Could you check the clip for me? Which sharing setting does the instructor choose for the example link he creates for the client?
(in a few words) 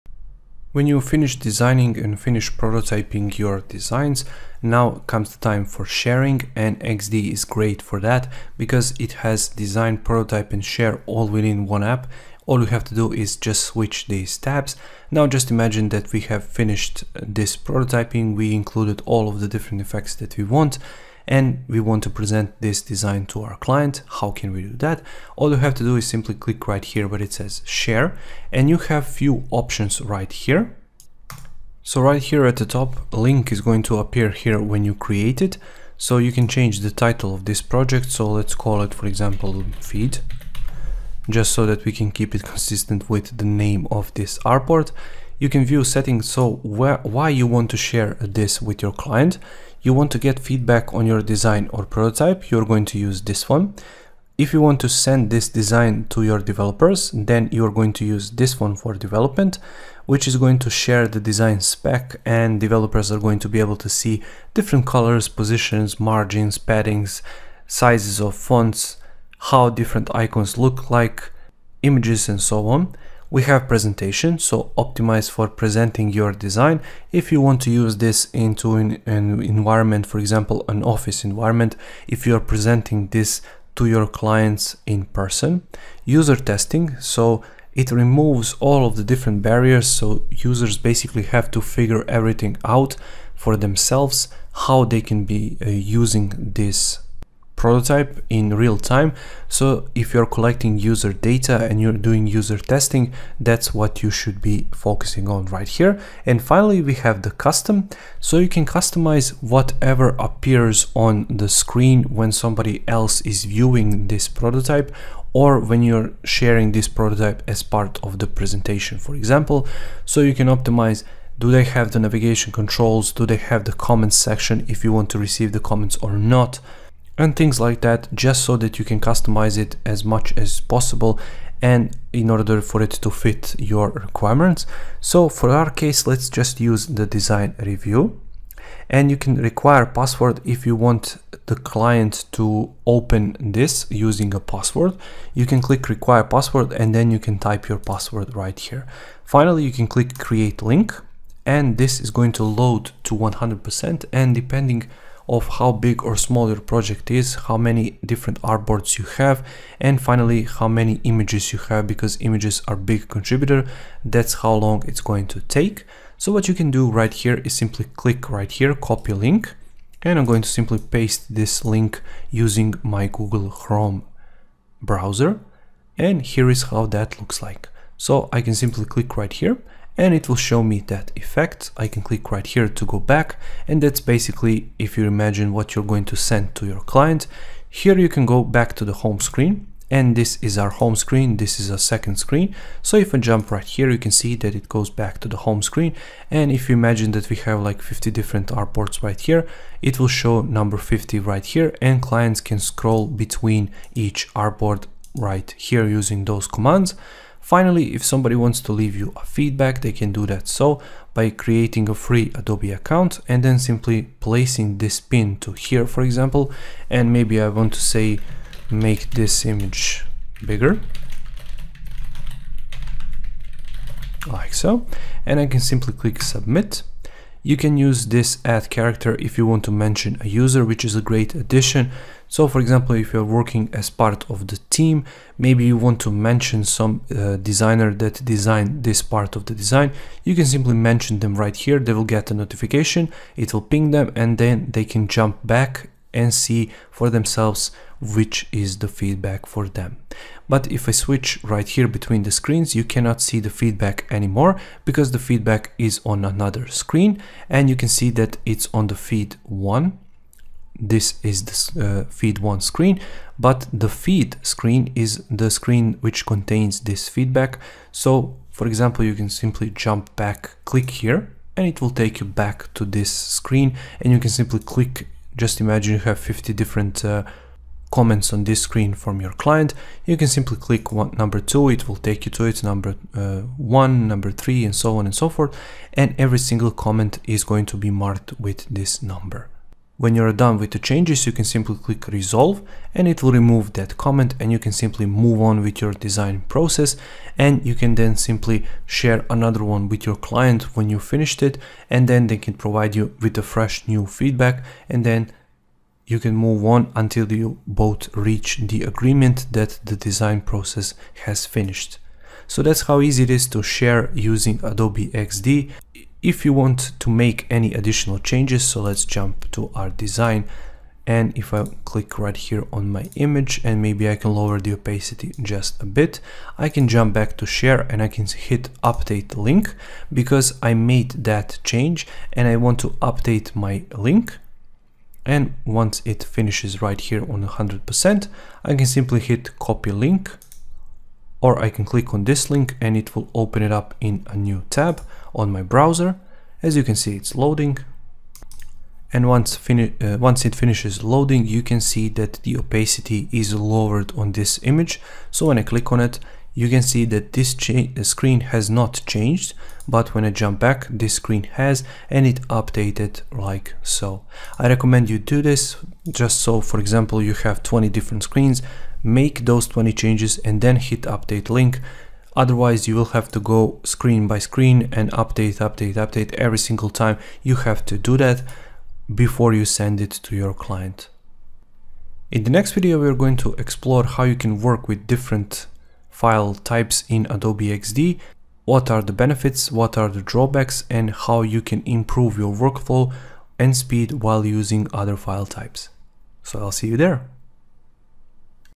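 design review.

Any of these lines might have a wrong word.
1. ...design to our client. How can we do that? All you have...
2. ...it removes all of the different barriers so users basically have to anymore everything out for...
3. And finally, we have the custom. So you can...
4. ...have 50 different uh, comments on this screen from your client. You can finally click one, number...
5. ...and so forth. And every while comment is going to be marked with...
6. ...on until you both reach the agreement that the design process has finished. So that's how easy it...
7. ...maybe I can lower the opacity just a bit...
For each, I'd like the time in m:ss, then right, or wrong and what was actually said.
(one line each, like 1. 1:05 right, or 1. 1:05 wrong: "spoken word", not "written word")
1. 0:22 right
2. 1:27 wrong: "figure", not "anymore"
3. 1:46 right
4. 4:35 wrong: "simply", not "finally"
5. 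4:45 wrong: "single", not "while"
6. 5:06 right
7. 5:23 right.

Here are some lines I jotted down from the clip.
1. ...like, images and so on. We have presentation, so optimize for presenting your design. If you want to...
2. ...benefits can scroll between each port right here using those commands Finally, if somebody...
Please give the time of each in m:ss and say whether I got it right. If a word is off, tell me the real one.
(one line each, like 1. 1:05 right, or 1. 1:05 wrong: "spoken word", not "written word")
1. 1:10 right
2. 3:22 wrong: "clients", not "benefits".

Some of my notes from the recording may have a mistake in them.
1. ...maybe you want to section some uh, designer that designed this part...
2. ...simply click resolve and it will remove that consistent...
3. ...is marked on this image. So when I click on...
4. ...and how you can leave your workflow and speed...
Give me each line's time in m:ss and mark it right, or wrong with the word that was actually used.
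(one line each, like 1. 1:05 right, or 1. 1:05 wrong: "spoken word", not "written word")
1. 3:55 wrong: "mention", not "section"
2. 4:51 wrong: "comment", not "consistent"
3. 5:53 wrong: "lowered", not "marked"
4. 6:30 wrong: "improve", not "leave".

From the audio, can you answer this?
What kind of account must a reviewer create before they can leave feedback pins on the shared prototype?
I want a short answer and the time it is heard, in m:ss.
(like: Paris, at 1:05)
free Adobe account, at 3:31.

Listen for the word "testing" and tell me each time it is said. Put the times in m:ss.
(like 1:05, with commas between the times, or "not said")
1:26, 1:42.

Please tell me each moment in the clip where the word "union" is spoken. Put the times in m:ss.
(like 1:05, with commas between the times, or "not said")
not said.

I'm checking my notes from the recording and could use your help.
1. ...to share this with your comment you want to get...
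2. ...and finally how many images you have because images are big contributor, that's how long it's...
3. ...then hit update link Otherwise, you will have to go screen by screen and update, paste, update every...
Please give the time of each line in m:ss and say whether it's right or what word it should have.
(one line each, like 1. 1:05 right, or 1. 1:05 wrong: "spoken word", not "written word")
1. 0:47 wrong: "client", not "comment"
2. 2:39 right
3. 6:10 wrong: "update", not "paste".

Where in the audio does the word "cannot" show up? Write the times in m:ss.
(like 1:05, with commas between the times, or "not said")
4:12.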